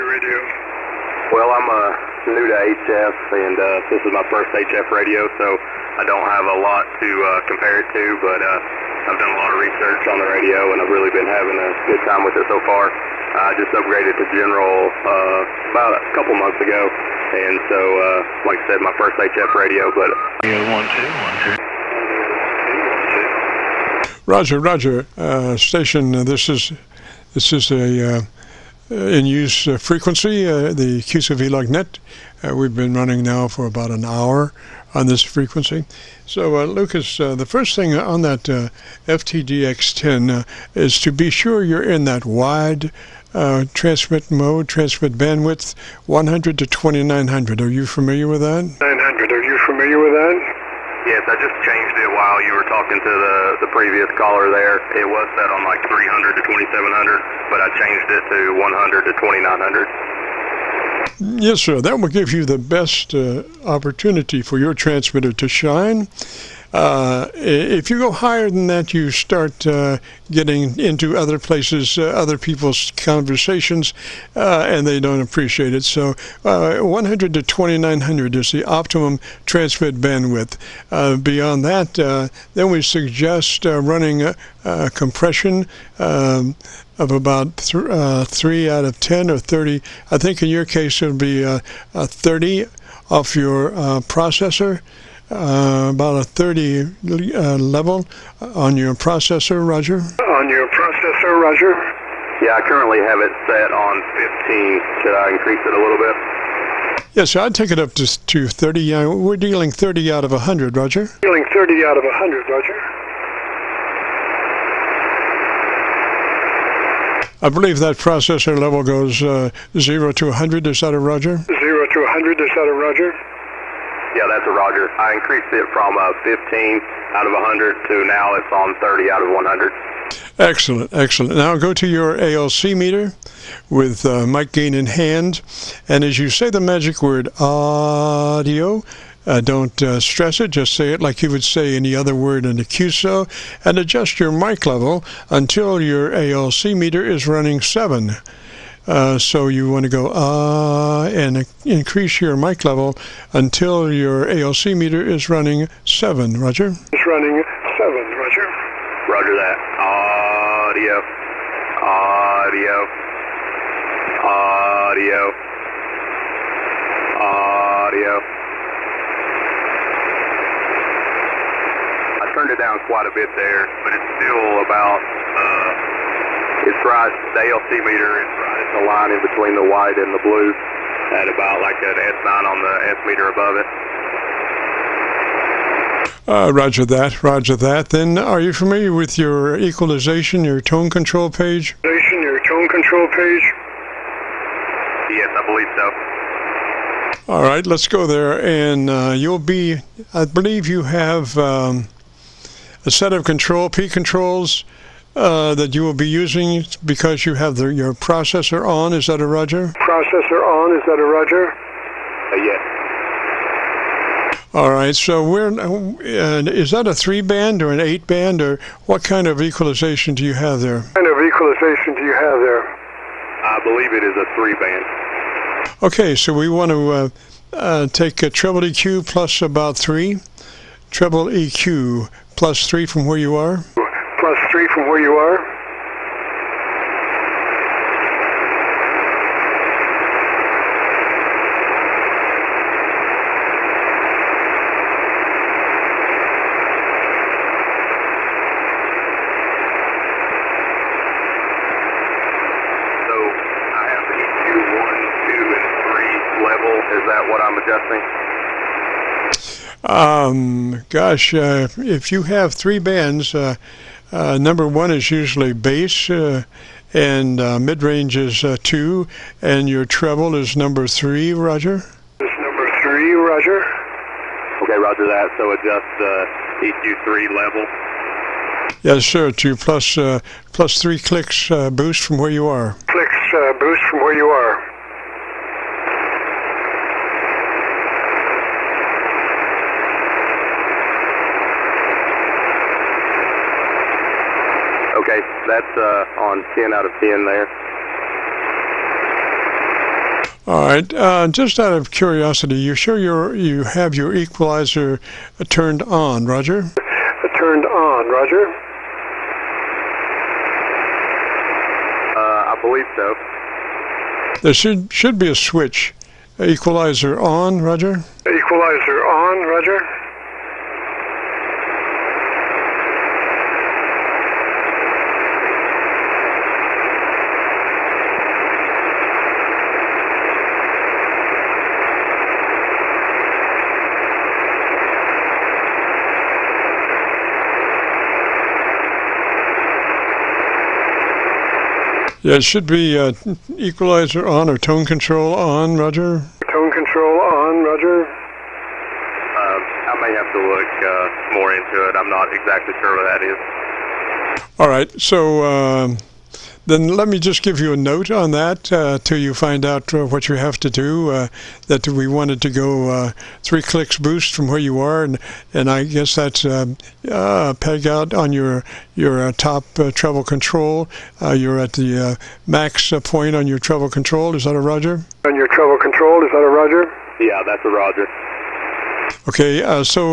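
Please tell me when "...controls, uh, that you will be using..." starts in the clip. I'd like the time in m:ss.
3:23.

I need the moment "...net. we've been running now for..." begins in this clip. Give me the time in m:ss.
0:31.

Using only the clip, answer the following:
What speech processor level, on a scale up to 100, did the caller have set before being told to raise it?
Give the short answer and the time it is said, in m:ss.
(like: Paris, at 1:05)
15, at 1:43.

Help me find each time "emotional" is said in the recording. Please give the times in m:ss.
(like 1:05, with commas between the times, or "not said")
not said.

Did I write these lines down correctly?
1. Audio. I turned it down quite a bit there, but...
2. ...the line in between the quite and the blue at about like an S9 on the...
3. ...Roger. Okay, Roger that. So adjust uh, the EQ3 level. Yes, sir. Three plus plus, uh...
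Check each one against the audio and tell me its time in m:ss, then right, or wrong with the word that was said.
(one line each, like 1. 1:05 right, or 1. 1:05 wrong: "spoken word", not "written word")
1. 2:47 right
2. 2:58 wrong: "white", not "quite"
3. 4:33 wrong: "Two", not "Three".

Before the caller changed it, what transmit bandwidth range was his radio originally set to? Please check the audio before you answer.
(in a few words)
300 to 2700.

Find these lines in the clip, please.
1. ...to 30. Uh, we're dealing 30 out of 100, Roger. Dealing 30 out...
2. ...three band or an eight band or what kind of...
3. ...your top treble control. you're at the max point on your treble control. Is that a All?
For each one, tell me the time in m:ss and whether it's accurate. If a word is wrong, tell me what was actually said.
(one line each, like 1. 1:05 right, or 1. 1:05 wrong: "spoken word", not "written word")
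1. 1:48 right
2. 3:36 right
3. 6:08 wrong: "Roger", not "All".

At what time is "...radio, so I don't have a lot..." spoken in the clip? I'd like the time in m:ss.
0:04.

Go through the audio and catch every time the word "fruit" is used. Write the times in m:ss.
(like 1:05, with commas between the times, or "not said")
not said.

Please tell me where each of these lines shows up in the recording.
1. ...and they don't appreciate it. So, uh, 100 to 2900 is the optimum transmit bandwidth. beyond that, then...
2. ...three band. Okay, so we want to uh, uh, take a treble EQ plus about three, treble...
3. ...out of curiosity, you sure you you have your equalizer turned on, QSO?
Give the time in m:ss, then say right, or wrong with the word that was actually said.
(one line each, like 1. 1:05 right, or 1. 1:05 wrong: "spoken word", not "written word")
1. 1:14 right
2. 3:44 right
3. 5:01 wrong: "Roger", not "QSO".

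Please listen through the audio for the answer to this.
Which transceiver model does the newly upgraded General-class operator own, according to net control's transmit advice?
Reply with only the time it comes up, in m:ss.
0:39.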